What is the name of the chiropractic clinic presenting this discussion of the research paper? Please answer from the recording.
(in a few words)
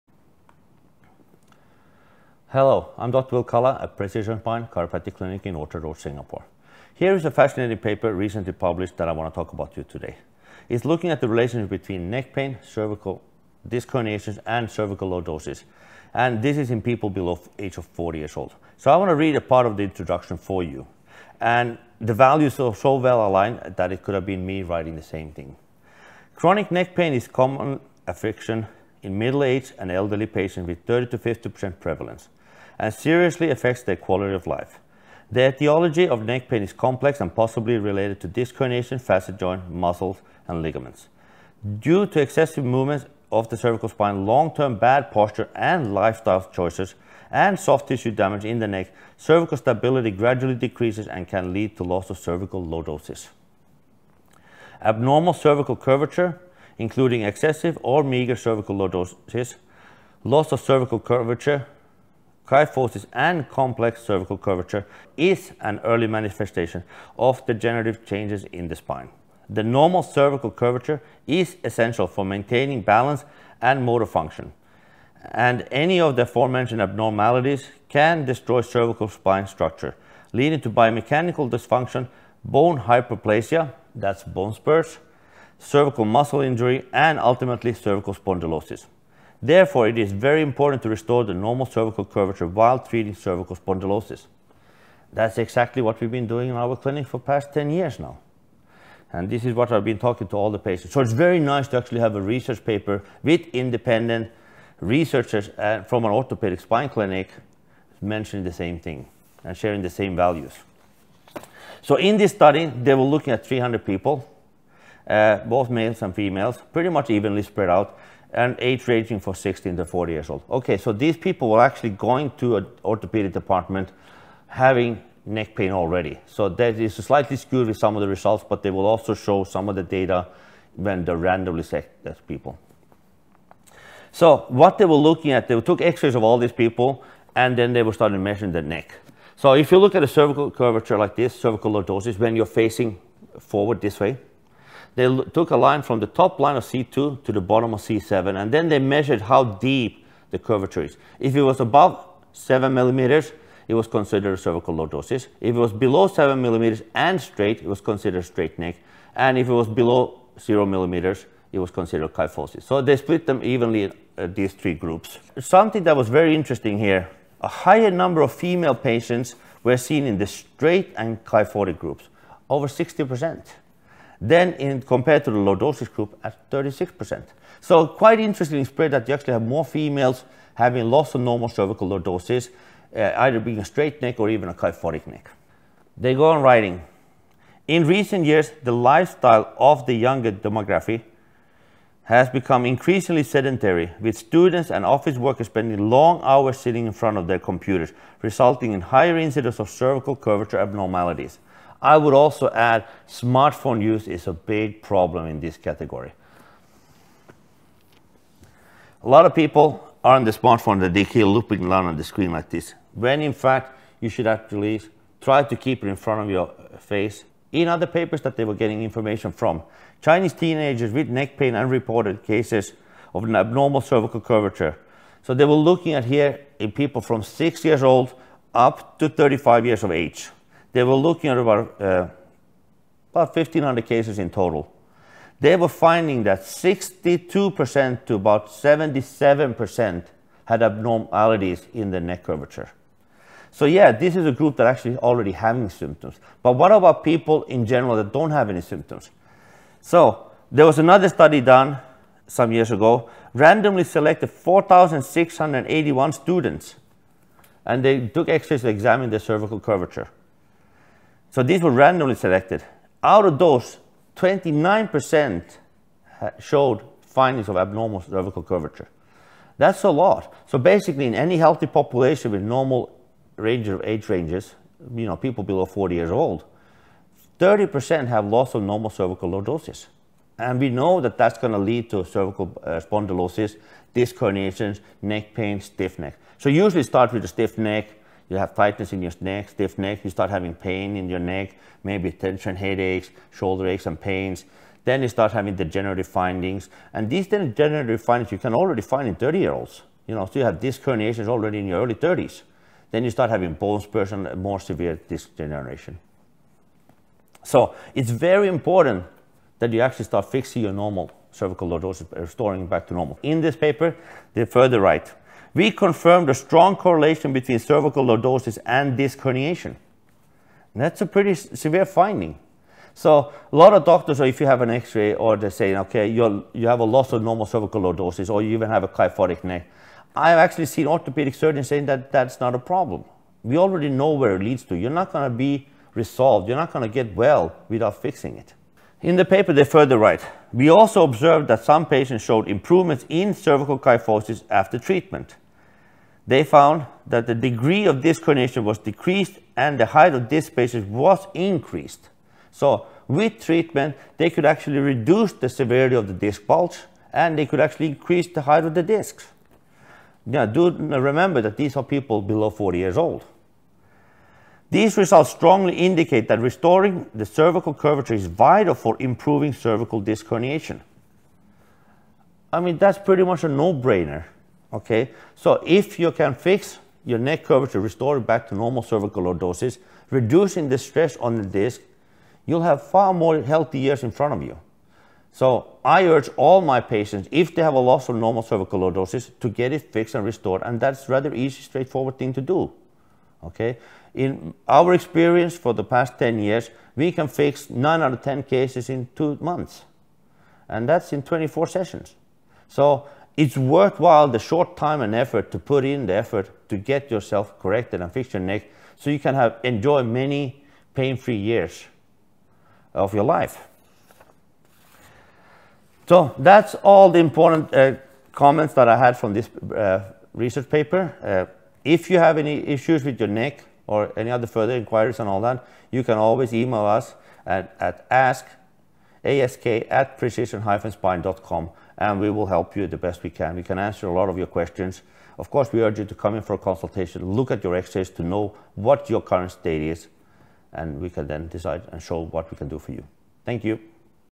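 Precision Spine Chiropractic Clinic.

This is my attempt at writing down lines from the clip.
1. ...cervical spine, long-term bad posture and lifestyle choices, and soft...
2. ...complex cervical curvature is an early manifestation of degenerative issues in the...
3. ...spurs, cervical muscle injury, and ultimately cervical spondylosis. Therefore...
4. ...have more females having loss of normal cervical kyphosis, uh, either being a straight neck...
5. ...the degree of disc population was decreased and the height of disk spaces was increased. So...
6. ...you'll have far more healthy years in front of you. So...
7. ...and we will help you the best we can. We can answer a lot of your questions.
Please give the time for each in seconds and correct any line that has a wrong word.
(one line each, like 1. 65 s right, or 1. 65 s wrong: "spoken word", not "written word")
1. 43 s right
2. 63 s wrong: "changes", not "issues"
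3. 84 s right
4. 179 s wrong: "lordosis", not "kyphosis"
5. 347 s wrong: "herniation", not "population"
6. 382 s right
7. 432 s right.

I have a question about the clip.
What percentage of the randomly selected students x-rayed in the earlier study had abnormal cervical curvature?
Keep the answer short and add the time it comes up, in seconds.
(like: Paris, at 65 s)
29%, at 264 s.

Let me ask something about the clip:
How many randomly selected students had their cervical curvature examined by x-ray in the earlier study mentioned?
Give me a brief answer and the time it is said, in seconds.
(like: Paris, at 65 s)
4,681, at 254 s.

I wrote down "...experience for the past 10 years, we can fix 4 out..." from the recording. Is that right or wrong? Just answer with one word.
wrong.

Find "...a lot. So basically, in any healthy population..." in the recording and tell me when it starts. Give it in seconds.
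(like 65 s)
269 s.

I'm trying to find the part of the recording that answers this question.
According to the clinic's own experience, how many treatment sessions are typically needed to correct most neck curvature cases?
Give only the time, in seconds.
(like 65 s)
401 s.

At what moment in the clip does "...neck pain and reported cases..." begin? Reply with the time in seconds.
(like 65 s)
221 s.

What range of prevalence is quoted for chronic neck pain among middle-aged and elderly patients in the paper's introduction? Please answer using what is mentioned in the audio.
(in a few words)
30 to 50%.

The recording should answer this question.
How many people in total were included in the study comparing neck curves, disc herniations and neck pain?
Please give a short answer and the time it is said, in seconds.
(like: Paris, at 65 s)
300, at 113 s.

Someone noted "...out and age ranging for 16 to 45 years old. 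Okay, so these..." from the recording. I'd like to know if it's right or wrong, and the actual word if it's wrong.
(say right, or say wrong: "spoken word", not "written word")
wrong: "40", not "45".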